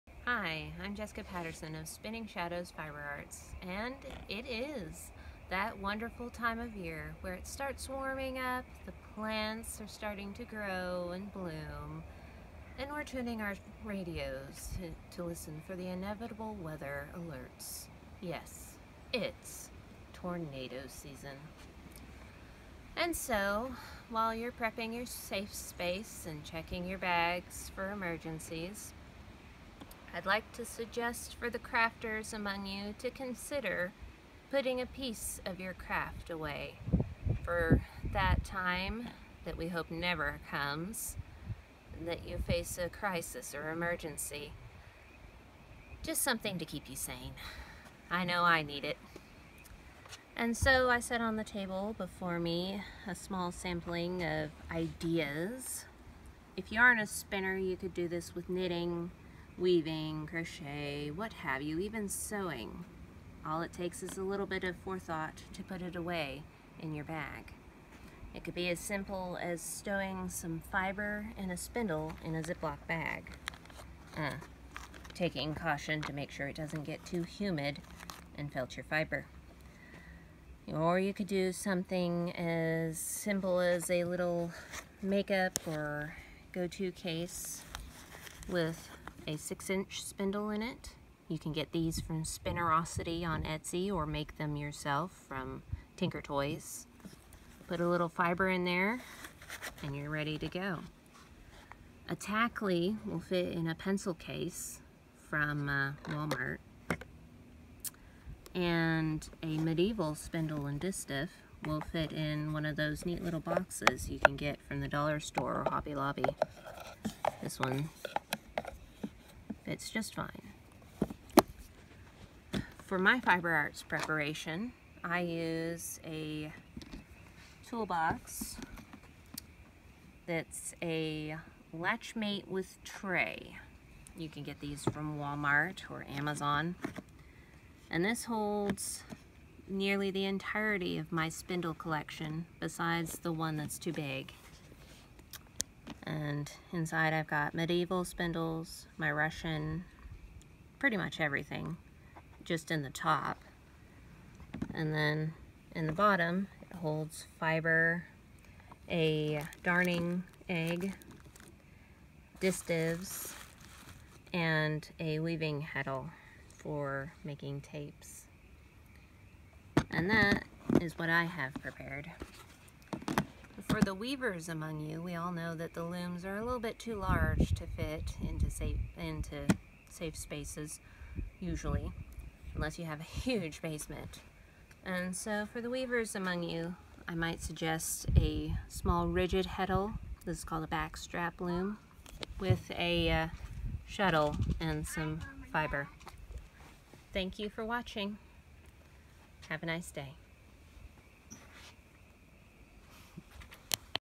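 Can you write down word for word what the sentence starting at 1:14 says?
Uh, taking caution to make sure it doesn't get too humid and felt your fiber.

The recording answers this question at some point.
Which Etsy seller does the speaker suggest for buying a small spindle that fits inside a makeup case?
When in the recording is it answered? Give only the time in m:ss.
1:32.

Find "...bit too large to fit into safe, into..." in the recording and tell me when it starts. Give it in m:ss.
2:56.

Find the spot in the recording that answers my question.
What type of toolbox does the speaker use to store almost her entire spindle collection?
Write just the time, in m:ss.
2:11.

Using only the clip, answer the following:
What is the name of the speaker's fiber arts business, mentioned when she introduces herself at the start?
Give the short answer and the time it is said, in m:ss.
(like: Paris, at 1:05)
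Spinning Shadows Fiber Arts, at 0:01.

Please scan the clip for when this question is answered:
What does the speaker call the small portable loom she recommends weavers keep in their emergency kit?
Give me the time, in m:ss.
3:10.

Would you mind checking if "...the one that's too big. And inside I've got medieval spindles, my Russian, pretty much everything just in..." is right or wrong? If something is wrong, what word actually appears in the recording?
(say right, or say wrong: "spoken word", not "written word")
right.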